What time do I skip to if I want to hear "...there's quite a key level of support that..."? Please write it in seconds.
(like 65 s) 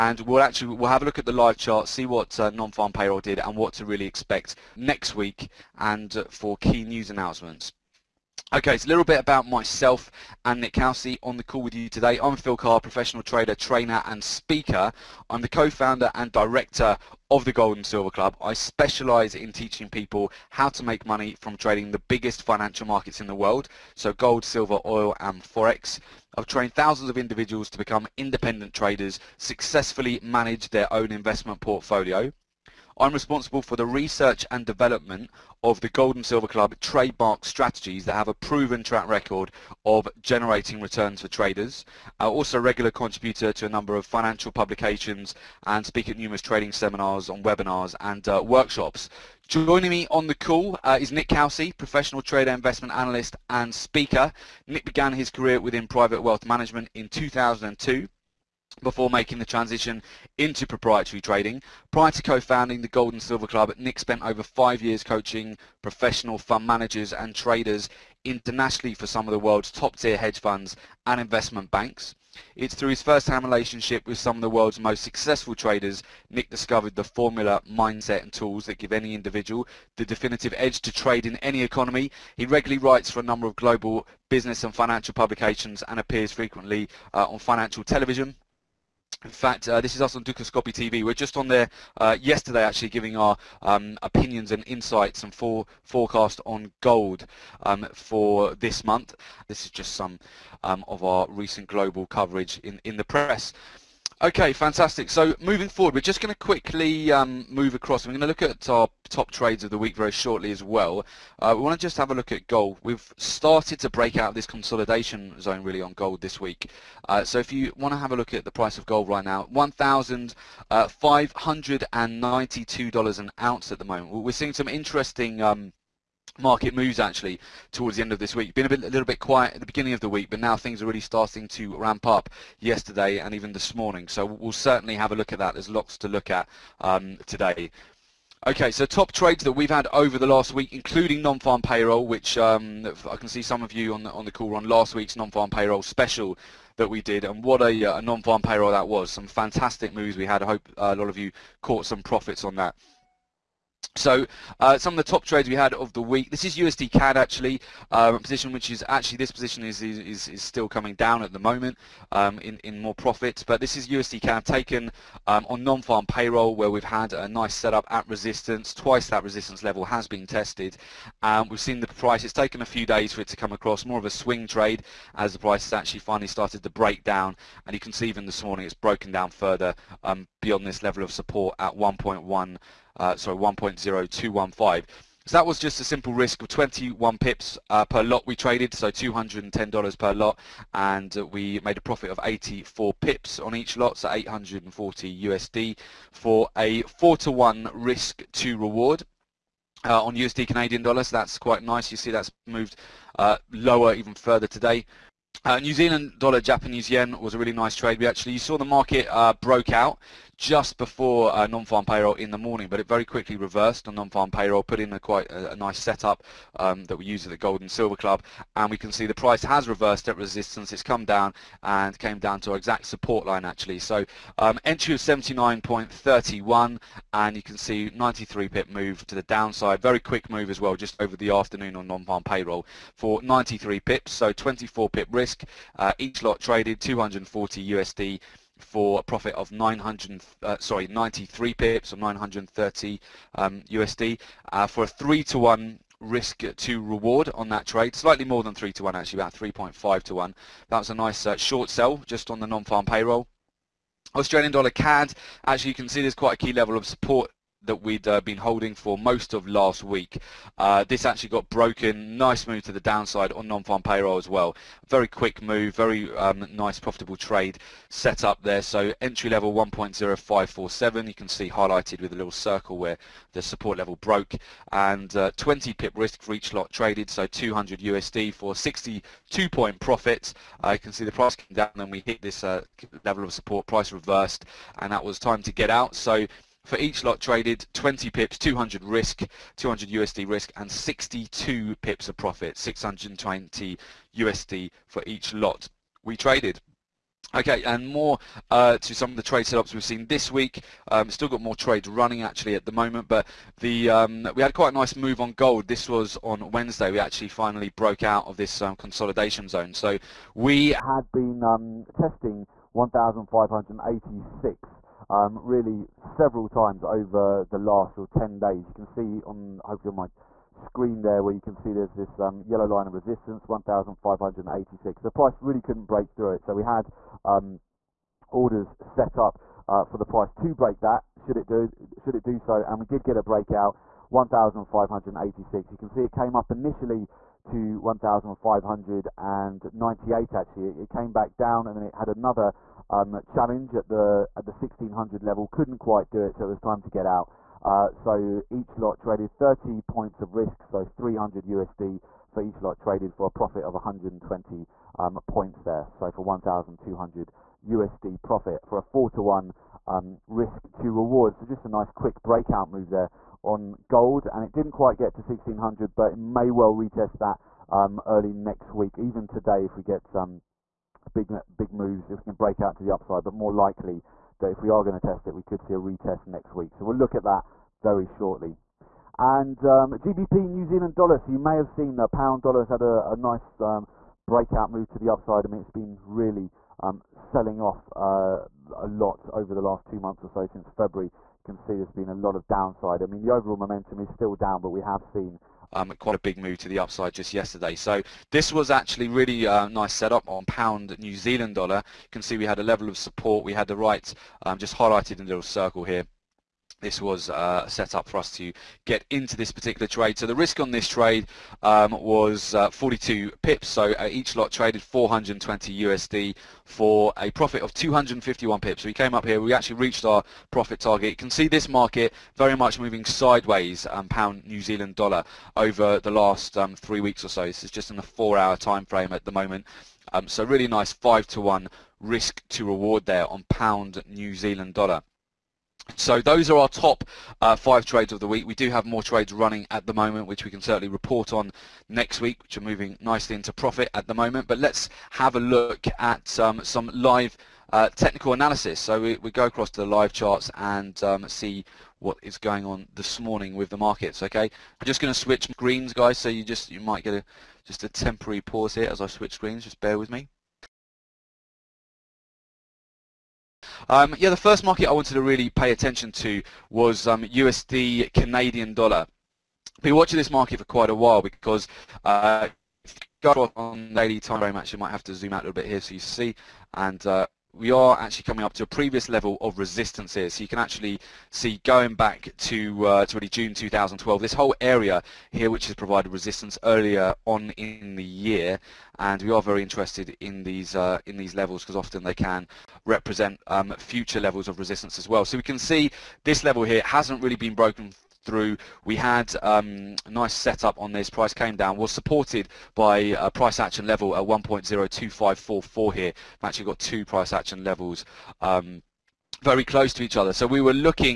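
256 s.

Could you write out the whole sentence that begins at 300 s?
Um, still got more trades running actually at the moment, but the um, we had quite a nice move on gold.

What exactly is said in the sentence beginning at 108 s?
We're going to look at our top trades of the week very shortly as well.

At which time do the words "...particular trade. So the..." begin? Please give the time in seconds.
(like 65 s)
409 s.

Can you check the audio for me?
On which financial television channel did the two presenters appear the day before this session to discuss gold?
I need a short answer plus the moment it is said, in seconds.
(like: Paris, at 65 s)
Dukascopy TV, at 90 s.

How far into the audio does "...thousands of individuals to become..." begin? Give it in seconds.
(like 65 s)
26 s.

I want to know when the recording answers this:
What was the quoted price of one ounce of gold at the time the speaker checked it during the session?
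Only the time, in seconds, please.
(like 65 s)
119 s.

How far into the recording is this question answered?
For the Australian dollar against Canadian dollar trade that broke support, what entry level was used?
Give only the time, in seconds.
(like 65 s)
269 s.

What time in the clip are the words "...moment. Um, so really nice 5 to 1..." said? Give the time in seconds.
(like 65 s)
429 s.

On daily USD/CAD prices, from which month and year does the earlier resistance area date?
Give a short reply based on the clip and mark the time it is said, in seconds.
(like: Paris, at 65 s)
June 2012, at 483 s.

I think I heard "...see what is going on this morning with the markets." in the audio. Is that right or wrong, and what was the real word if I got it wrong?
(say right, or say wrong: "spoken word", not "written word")
right.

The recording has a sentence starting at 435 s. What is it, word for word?
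So those are our top uh, five trades of the week.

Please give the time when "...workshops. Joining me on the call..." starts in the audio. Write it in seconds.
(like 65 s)
48 s.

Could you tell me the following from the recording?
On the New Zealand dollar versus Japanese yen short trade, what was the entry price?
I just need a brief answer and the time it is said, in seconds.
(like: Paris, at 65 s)
79.31, at 224 s.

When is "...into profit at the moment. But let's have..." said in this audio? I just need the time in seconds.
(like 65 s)
443 s.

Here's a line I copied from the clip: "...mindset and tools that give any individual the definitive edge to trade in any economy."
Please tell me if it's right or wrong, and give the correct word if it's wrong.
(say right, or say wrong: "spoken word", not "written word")
right.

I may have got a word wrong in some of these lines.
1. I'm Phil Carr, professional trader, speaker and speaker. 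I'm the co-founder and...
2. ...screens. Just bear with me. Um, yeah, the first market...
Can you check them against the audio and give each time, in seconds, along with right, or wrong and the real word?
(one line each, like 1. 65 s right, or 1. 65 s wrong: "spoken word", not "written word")
1. 12 s wrong: "trainer", not "speaker"
2. 459 s right.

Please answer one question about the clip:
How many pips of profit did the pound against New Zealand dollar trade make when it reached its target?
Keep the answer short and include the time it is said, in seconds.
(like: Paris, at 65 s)
251 pips, at 417 s.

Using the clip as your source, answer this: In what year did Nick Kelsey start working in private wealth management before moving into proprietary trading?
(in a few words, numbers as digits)
2002.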